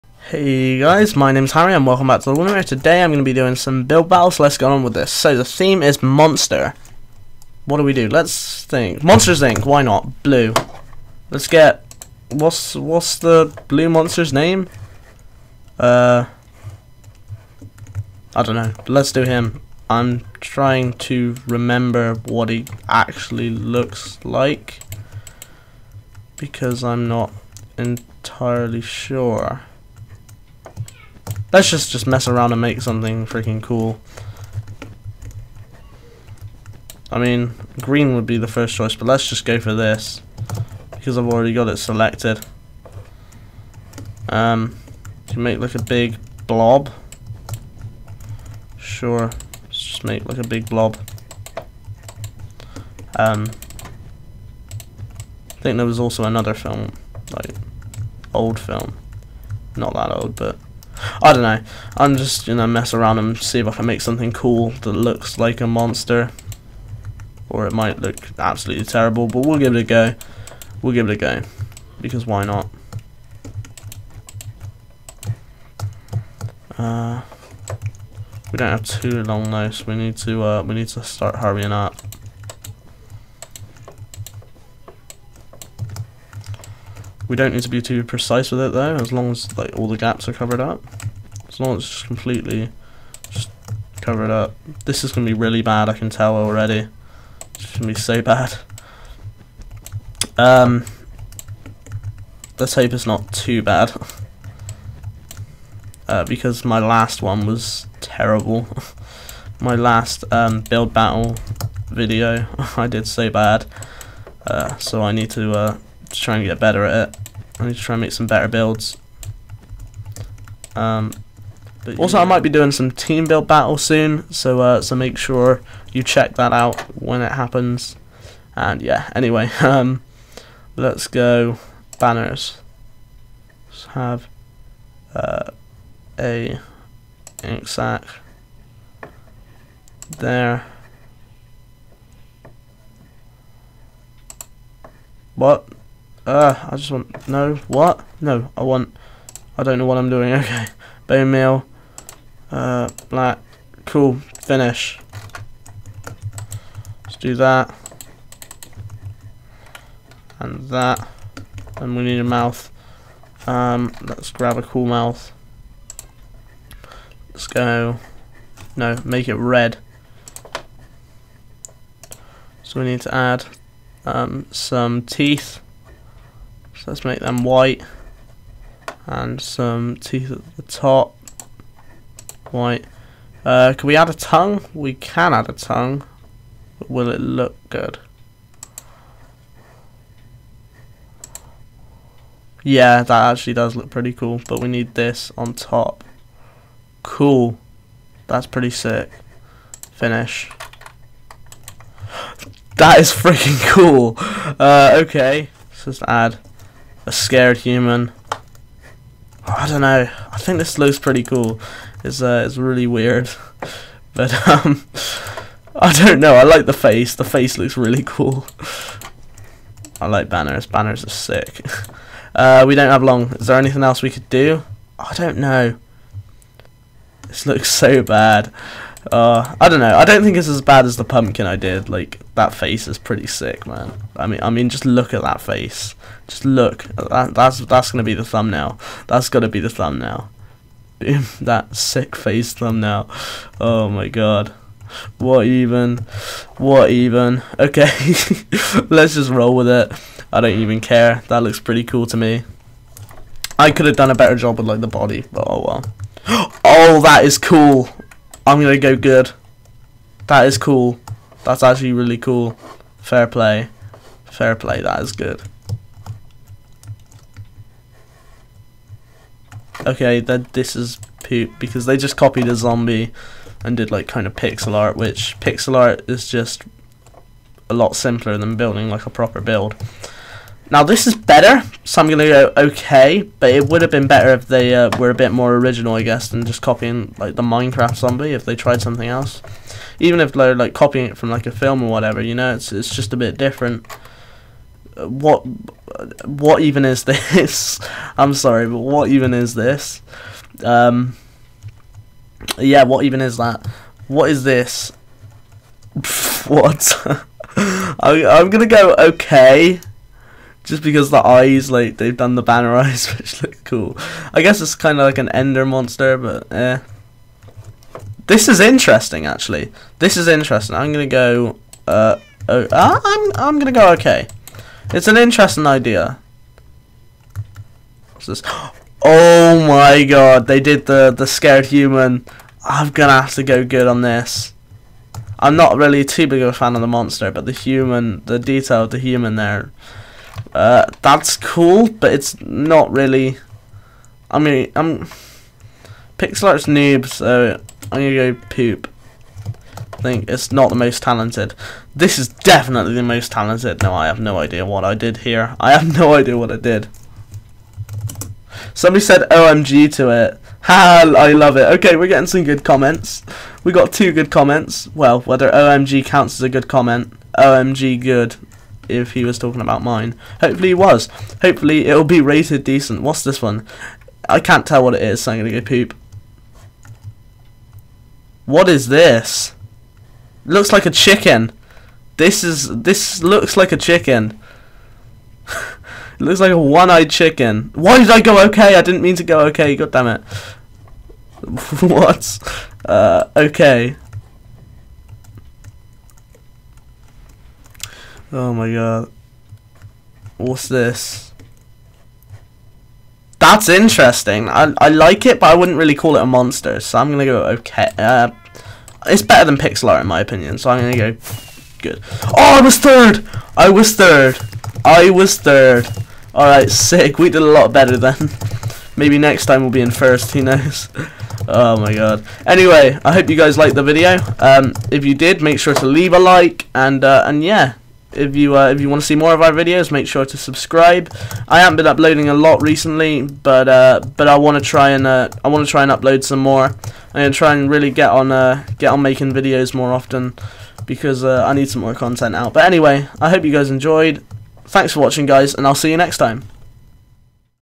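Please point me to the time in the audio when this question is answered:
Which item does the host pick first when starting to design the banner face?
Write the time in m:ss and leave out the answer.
2:17.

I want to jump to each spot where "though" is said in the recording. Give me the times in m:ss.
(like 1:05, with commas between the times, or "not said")
1:19, 1:28.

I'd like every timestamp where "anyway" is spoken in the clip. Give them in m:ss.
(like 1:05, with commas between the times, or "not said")
2:09, 7:02, 7:22.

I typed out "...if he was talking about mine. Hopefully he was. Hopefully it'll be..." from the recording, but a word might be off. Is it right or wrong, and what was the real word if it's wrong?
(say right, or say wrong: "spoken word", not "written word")
right.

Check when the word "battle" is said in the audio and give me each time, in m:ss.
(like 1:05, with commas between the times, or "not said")
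0:04, 1:50, 2:03.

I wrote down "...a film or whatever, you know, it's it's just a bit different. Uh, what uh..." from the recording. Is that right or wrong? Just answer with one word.
right.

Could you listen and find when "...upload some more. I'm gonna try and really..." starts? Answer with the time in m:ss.
7:15.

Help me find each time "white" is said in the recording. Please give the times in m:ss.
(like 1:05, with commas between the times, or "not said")
2:57, 3:02.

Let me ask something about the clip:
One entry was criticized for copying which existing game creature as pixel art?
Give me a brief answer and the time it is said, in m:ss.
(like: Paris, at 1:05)
Minecraft zombie, at 4:47.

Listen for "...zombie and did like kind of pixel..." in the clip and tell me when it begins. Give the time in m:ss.
4:32.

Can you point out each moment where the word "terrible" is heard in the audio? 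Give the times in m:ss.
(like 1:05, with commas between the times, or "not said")
1:08, 1:48.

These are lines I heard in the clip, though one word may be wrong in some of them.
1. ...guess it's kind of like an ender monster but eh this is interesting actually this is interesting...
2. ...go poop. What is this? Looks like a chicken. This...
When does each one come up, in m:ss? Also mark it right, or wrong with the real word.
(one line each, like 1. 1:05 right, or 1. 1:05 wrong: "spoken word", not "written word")
1. 5:14 right
2. 6:15 right.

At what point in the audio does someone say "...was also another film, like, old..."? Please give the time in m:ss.
0:55.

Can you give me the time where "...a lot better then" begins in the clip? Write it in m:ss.
6:57.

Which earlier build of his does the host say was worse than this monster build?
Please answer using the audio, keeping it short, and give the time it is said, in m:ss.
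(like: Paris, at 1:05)
the pumpkin, at 3:50.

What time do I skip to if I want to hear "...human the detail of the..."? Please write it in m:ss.
5:37.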